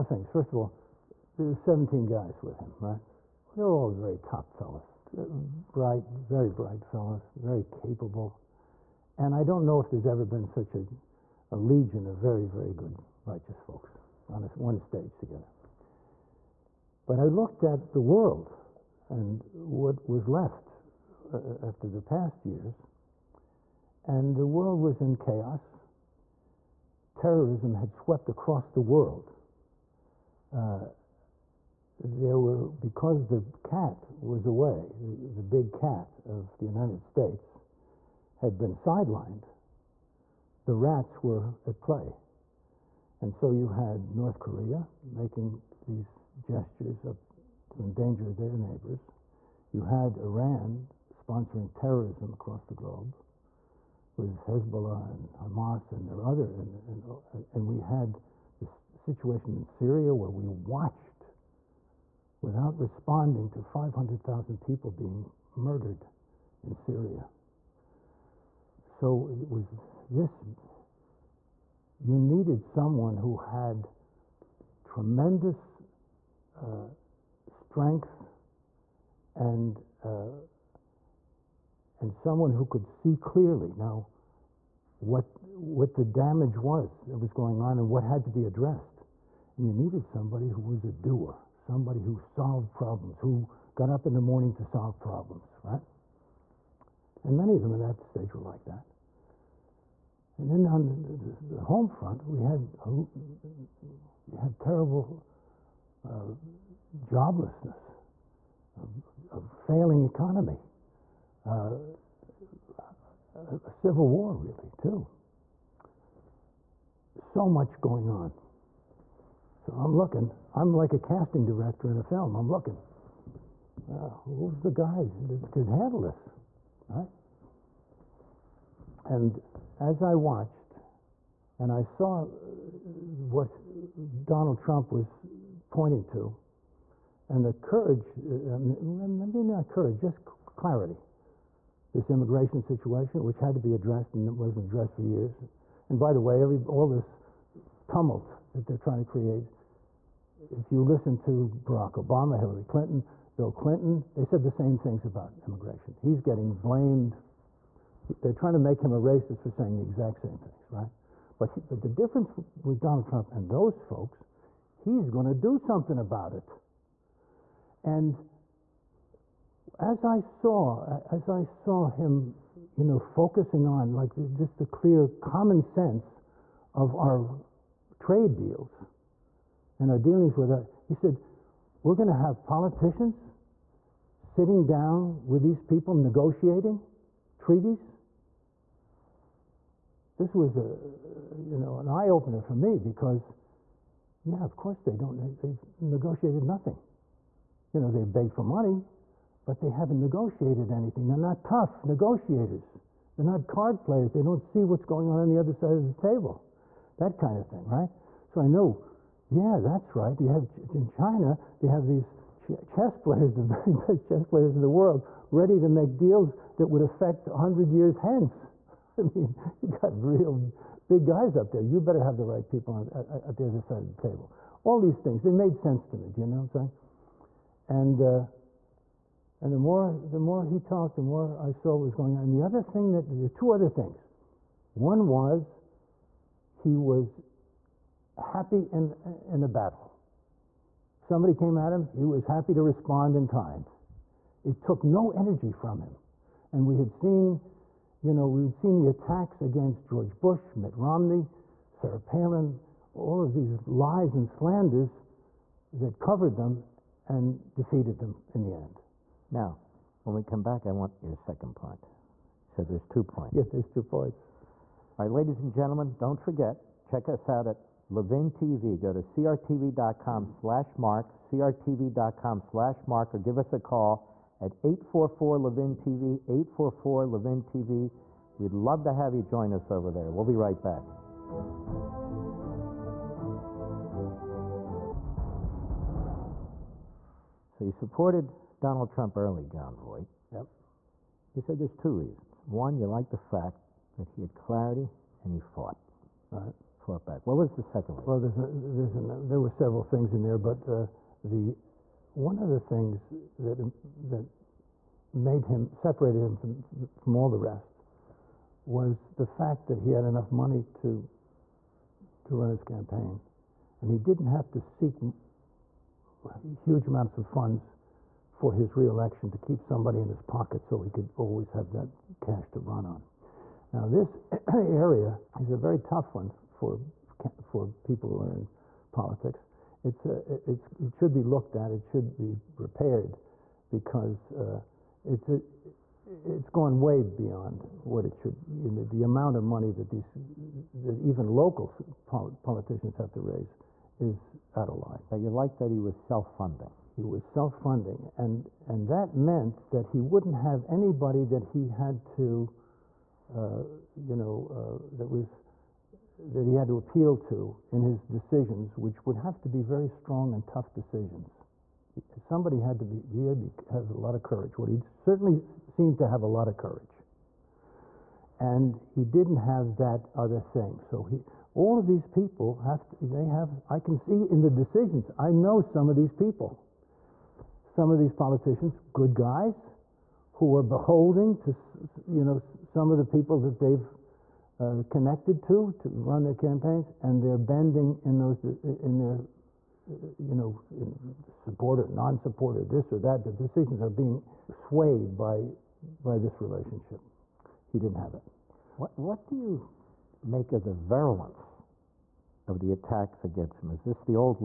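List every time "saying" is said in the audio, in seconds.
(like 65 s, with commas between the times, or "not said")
159 s, 226 s.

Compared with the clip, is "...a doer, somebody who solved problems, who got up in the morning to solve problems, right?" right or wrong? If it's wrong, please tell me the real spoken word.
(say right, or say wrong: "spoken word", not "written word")
right.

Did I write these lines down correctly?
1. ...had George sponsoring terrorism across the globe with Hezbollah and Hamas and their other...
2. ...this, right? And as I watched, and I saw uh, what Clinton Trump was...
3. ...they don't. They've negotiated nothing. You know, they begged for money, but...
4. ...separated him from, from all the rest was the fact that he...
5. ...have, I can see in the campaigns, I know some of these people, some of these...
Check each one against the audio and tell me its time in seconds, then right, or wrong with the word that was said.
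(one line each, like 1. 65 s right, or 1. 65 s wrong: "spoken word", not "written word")
1. 49 s wrong: "Iran", not "George"
2. 126 s wrong: "Donald", not "Clinton"
3. 194 s right
4. 305 s right
5. 373 s wrong: "decisions", not "campaigns".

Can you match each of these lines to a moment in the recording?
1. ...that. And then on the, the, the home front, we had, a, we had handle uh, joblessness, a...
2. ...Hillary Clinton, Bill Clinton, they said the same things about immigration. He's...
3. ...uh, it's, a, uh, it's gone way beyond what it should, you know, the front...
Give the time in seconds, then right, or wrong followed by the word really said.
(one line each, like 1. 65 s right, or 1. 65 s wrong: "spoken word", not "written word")
1. 98 s wrong: "terrible", not "handle"
2. 152 s right
3. 334 s wrong: "amount", not "front".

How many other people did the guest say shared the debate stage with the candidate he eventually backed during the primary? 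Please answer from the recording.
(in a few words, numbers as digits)
17.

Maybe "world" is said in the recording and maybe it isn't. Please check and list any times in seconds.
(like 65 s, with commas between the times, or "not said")
18 s, 24 s, 28 s, 214 s.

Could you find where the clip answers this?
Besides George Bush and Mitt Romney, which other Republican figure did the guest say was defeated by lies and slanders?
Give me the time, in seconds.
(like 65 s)
251 s.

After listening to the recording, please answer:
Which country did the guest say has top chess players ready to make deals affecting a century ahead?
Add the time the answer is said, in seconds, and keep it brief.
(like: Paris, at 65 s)
China, at 210 s.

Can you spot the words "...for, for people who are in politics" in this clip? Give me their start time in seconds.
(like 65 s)
326 s.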